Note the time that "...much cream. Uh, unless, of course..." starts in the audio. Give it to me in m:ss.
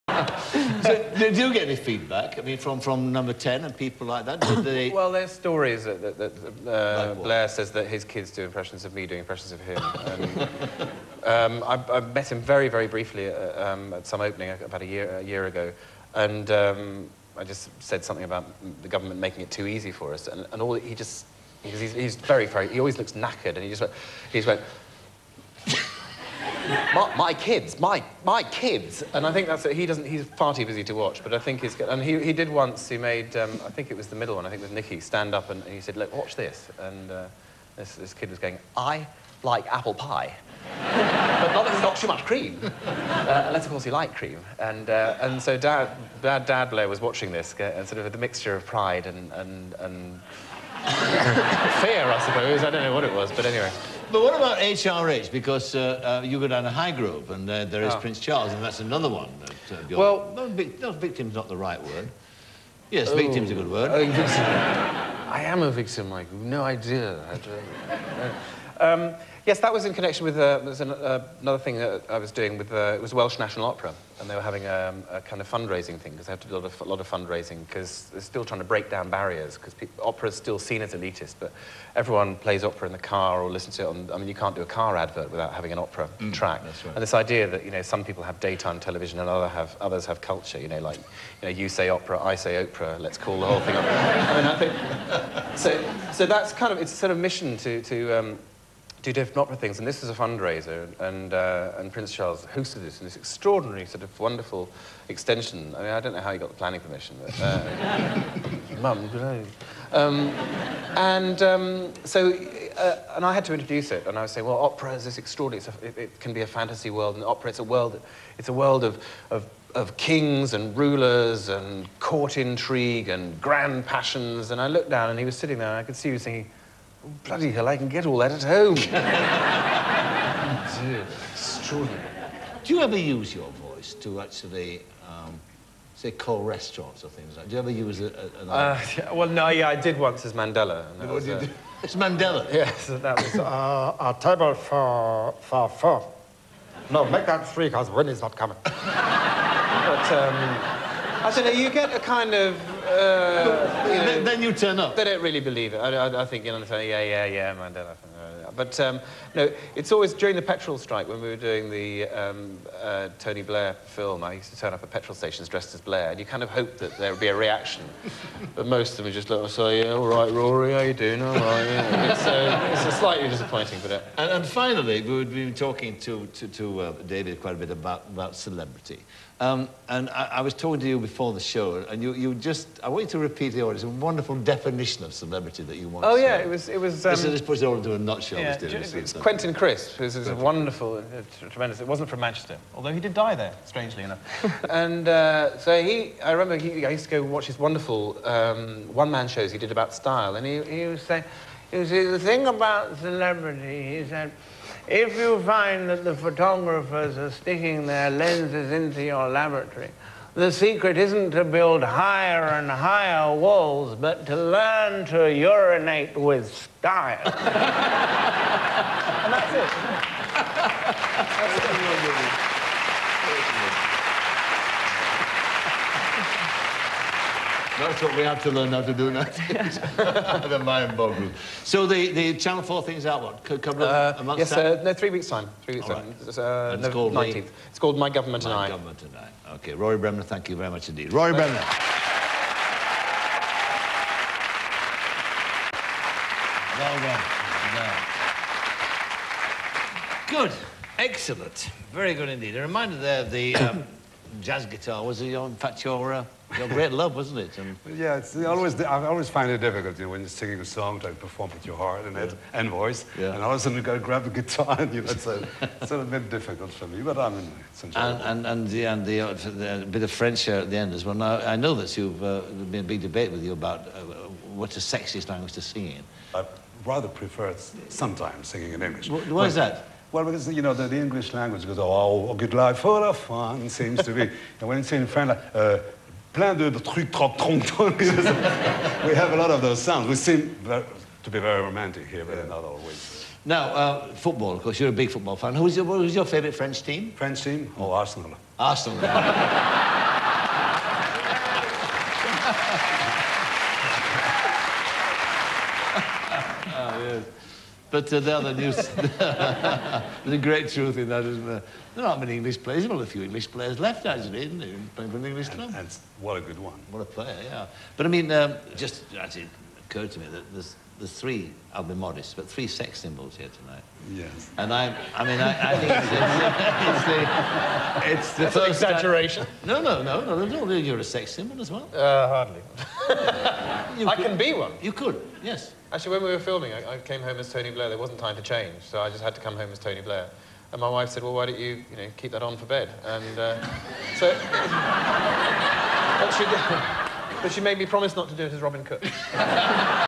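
0:42.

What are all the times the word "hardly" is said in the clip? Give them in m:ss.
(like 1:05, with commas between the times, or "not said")
5:32.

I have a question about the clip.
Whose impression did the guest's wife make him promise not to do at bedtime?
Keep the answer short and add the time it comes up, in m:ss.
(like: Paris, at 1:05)
Robin Cook, at 5:48.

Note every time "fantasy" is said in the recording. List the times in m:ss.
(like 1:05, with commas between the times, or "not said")
1:56.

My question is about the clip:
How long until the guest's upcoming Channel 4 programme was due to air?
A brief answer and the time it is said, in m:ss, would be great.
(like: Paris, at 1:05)
3 weeks, at 3:54.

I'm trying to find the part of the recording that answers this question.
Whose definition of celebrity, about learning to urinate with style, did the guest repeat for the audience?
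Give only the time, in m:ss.
3:09.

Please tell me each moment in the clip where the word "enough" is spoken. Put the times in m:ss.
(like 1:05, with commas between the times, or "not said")
3:14.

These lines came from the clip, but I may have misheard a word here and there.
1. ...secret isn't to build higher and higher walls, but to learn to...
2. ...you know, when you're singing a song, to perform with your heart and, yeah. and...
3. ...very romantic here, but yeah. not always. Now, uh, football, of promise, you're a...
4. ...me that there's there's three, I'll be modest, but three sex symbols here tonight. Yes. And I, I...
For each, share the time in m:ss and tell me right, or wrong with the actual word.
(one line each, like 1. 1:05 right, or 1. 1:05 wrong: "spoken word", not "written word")
1. 3:30 right
2. 4:19 right
3. 4:51 wrong: "course", not "promise"
4. 5:20 right.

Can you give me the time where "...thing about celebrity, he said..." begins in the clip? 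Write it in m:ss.
3:22.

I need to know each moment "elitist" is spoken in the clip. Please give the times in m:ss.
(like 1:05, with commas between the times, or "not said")
1:20.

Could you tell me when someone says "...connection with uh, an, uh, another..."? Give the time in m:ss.
1:09.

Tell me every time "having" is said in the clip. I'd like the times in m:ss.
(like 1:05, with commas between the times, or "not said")
1:14, 1:25.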